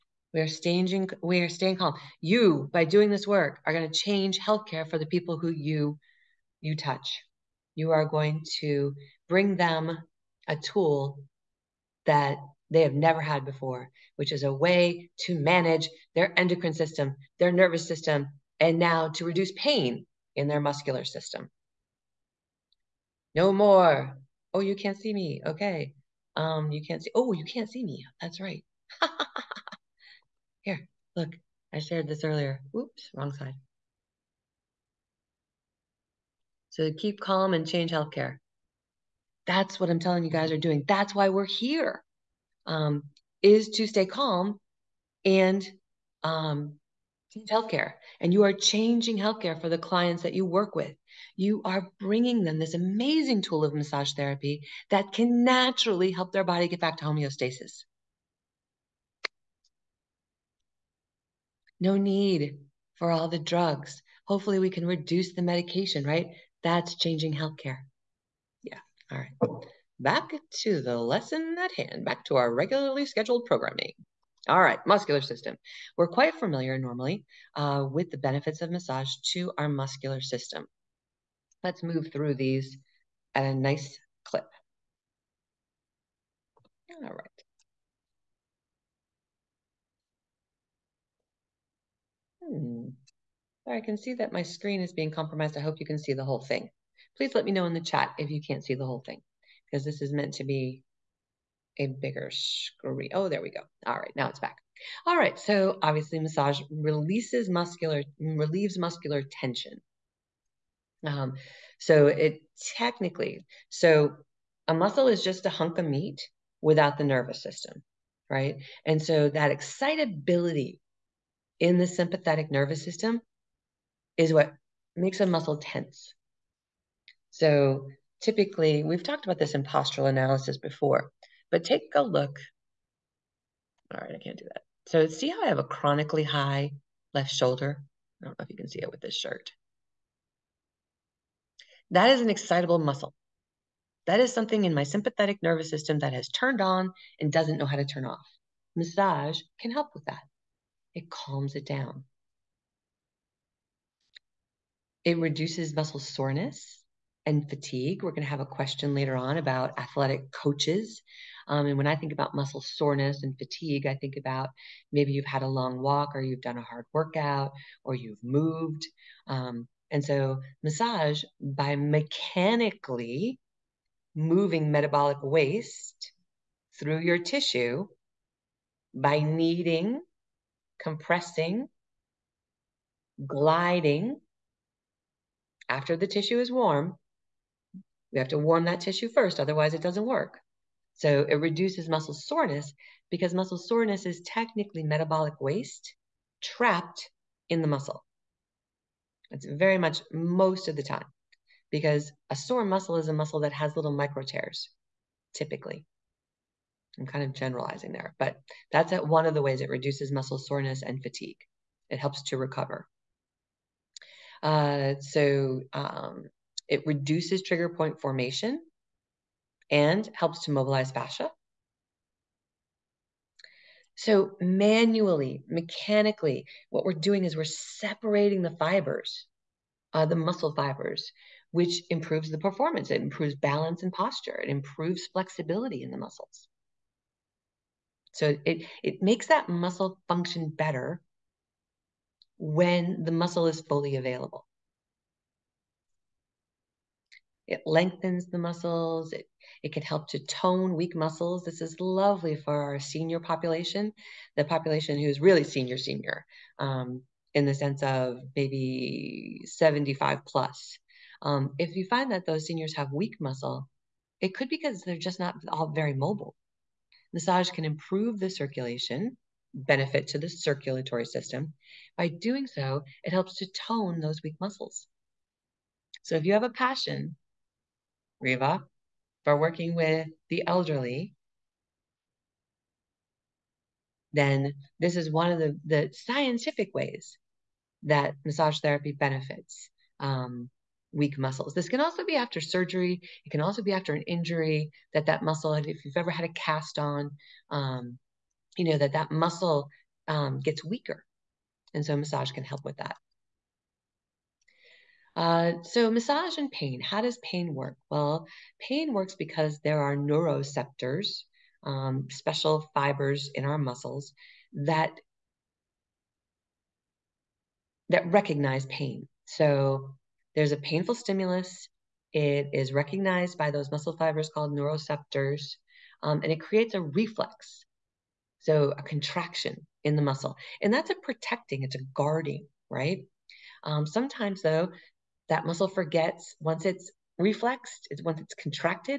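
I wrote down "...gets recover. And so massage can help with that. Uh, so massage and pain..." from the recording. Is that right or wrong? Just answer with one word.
wrong.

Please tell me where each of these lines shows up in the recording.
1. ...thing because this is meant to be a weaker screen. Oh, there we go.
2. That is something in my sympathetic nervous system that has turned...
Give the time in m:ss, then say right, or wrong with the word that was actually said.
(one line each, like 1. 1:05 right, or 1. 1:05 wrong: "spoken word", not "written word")
1. 1:39 wrong: "bigger", not "weaker"
2. 2:24 right.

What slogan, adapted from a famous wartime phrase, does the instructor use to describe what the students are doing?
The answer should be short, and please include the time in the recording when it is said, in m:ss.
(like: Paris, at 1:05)
Keep calm and change healthcare, at 0:36.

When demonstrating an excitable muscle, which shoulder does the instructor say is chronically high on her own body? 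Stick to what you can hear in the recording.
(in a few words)
Left shoulder.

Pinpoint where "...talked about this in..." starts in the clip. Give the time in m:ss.
2:09.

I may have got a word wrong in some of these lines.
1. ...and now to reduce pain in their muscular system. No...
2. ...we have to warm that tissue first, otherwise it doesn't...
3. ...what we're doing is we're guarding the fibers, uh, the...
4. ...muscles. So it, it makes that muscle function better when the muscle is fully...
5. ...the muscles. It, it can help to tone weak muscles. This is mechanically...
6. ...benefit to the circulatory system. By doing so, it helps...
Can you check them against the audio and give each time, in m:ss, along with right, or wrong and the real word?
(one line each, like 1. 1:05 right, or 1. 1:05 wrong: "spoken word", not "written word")
1. 0:18 right
2. 3:08 right
3. 3:46 wrong: "separating", not "guarding"
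4. 3:55 right
5. 4:08 wrong: "lovely", not "mechanically"
6. 4:29 right.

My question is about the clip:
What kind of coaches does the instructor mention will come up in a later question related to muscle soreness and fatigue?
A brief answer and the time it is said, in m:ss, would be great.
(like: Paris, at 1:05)
Athletic coaches, at 2:39.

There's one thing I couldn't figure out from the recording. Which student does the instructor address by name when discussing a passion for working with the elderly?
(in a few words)
Riva.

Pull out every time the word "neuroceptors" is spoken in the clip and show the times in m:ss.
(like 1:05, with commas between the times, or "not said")
5:09, 5:24.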